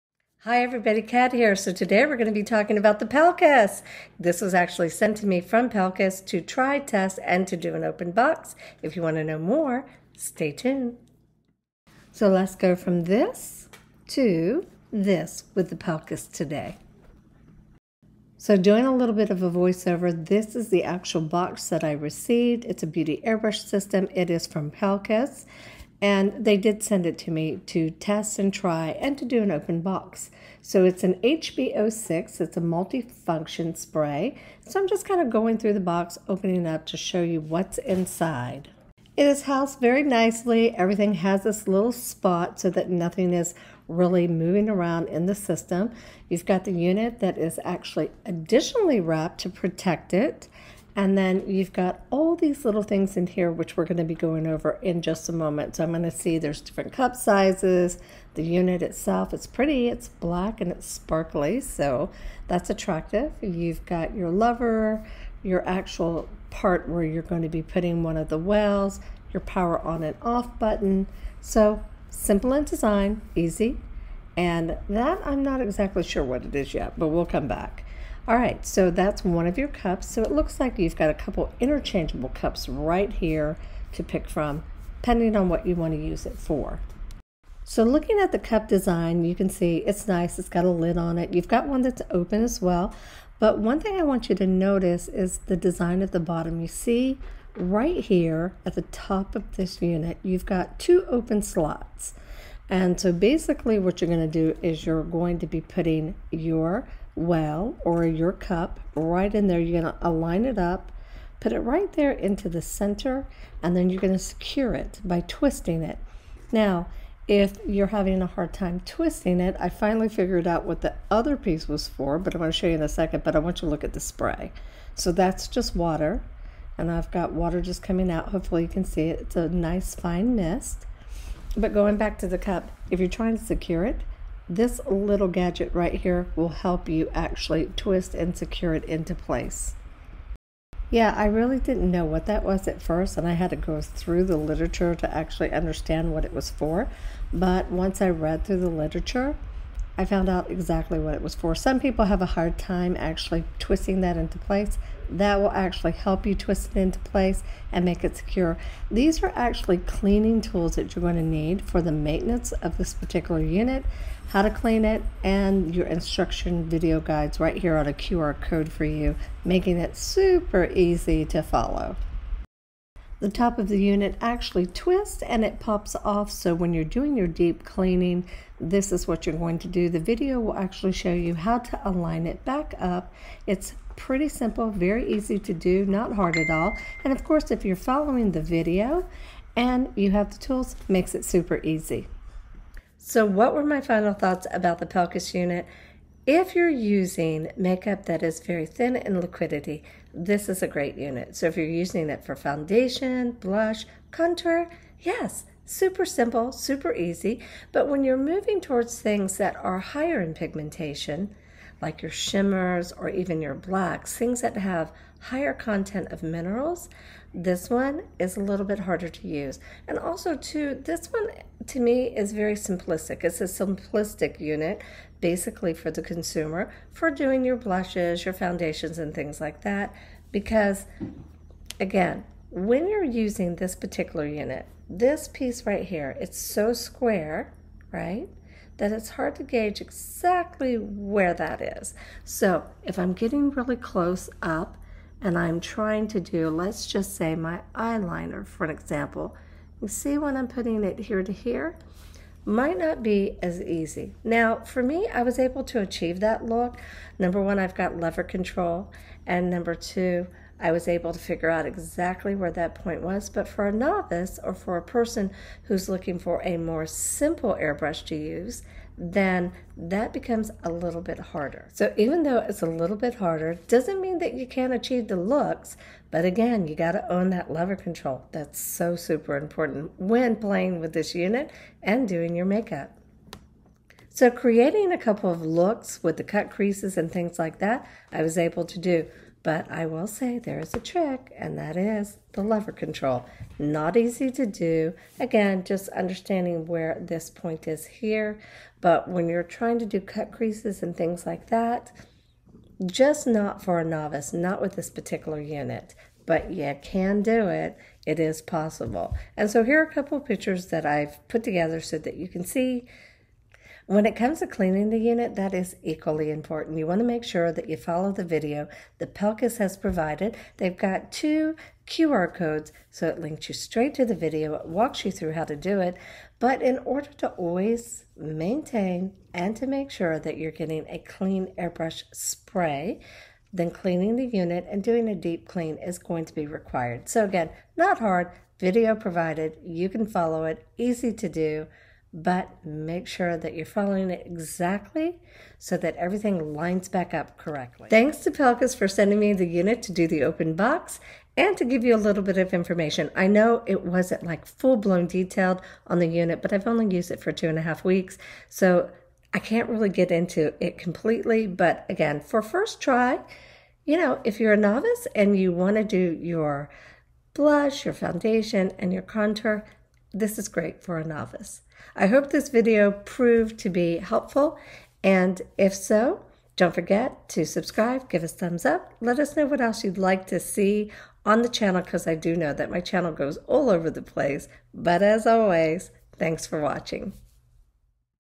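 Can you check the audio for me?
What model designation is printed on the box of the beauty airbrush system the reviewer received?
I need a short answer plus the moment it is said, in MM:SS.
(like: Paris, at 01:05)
HBO6, at 00:31.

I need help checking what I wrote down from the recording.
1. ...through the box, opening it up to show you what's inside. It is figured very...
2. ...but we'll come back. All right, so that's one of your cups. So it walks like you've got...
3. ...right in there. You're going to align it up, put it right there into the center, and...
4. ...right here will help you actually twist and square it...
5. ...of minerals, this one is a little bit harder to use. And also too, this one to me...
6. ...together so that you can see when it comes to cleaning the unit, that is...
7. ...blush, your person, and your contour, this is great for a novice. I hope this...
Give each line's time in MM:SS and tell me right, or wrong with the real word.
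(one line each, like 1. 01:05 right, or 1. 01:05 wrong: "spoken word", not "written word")
1. 00:35 wrong: "housed", not "figured"
2. 01:16 wrong: "looks", not "walks"
3. 01:48 right
4. 02:15 wrong: "secure", not "square"
5. 03:36 right
6. 05:11 right
7. 06:07 wrong: "foundation", not "person".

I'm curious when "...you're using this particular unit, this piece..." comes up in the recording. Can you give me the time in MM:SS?
03:52.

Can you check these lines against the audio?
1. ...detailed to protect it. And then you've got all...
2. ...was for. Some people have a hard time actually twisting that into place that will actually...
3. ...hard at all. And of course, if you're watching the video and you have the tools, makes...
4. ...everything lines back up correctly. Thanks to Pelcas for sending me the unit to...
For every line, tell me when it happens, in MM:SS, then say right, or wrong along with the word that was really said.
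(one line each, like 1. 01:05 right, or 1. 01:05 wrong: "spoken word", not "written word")
1. 00:49 wrong: "wrapped", not "detailed"
2. 02:31 right
3. 03:06 wrong: "following", not "watching"
4. 05:45 right.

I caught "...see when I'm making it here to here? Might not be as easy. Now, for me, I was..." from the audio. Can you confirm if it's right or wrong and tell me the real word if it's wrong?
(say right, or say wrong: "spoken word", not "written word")
wrong: "putting", not "making".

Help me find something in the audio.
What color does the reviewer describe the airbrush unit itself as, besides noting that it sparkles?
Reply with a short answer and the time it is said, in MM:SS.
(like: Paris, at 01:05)
Black, at 01:00.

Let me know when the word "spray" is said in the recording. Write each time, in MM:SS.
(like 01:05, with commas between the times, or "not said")
00:33, 02:03, 05:32.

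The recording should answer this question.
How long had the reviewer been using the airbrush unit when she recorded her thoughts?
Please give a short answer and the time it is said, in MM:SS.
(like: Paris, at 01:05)
2.5 weeks, at 05:57.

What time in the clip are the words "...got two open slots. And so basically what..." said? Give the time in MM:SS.
01:40.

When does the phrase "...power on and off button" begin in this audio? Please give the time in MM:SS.
01:09.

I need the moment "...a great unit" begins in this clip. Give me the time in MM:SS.
03:20.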